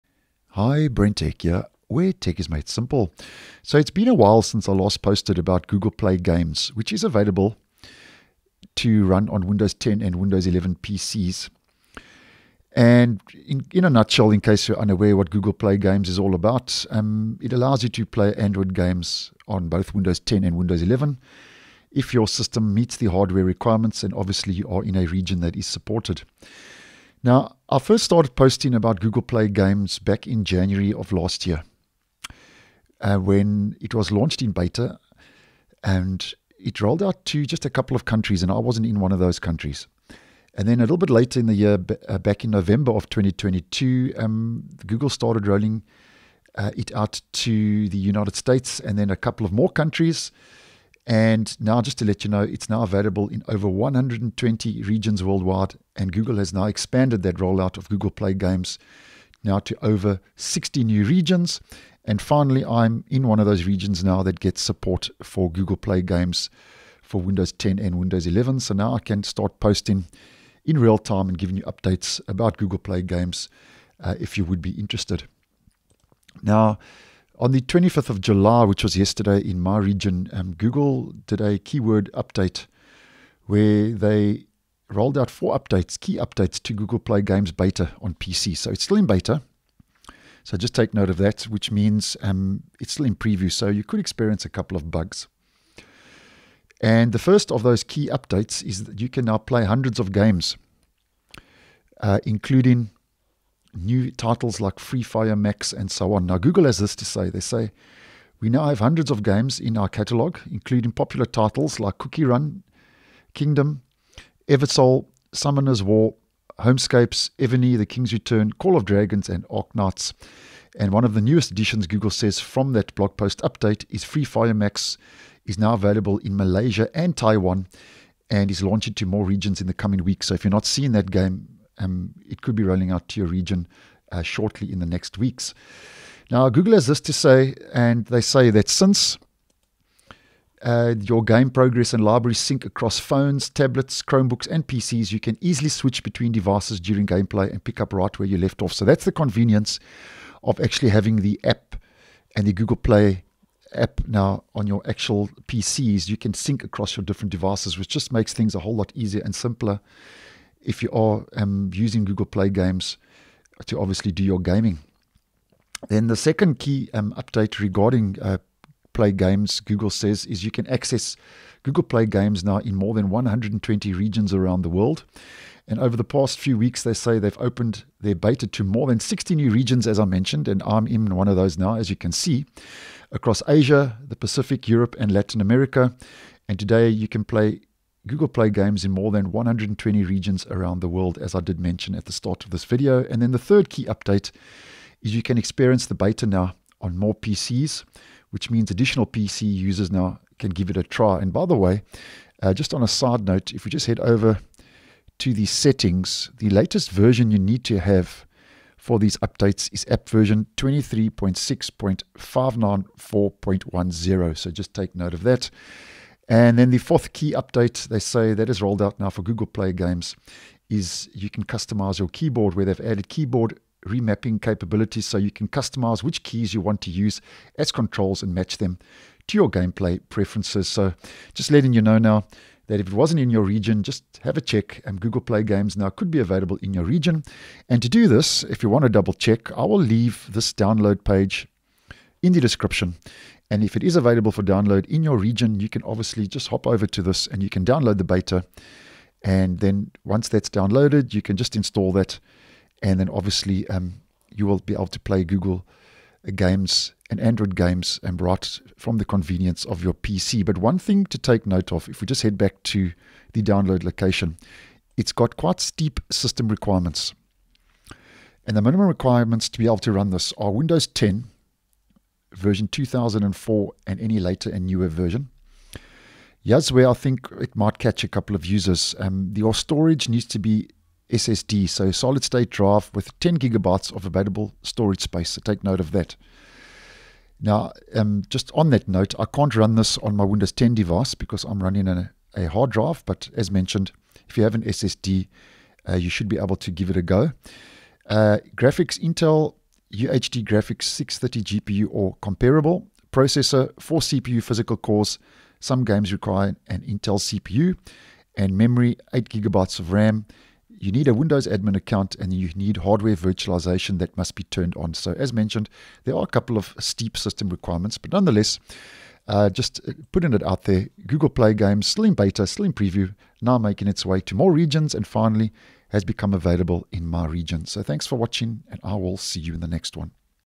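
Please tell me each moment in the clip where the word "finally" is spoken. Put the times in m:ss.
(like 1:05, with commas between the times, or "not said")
1:02, 5:25.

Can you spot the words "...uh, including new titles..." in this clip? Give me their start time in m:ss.
1:42.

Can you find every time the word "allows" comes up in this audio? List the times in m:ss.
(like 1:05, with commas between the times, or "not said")
0:17.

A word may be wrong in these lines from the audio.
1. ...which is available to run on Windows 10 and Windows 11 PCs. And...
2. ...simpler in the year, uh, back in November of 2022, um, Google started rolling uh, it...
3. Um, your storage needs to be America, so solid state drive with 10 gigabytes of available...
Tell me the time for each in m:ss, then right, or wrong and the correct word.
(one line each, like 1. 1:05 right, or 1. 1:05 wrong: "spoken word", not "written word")
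1. 0:06 right
2. 0:41 wrong: "later", not "simpler"
3. 4:38 wrong: "SSD", not "America".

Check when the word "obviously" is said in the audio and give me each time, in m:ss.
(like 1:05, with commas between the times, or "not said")
0:24, 2:43, 4:05, 4:13.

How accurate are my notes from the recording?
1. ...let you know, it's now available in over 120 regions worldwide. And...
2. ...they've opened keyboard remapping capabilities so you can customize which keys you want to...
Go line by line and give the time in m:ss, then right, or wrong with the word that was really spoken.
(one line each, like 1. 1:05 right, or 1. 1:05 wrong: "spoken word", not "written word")
1. 0:52 right
2. 3:42 wrong: "added", not "opened".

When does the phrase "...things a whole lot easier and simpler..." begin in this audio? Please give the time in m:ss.
2:38.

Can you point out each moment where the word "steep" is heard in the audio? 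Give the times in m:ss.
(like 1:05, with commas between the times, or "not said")
4:25, 5:16.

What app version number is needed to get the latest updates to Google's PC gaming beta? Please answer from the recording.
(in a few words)
23.6.594.10.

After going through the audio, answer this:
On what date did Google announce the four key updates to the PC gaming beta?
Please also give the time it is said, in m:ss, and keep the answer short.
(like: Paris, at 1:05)
25th of July, at 1:17.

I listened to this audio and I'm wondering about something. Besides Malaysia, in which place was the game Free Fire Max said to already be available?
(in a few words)
Taiwan.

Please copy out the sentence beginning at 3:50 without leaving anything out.
So just letting you know now that if it wasn't in your region, just have a check.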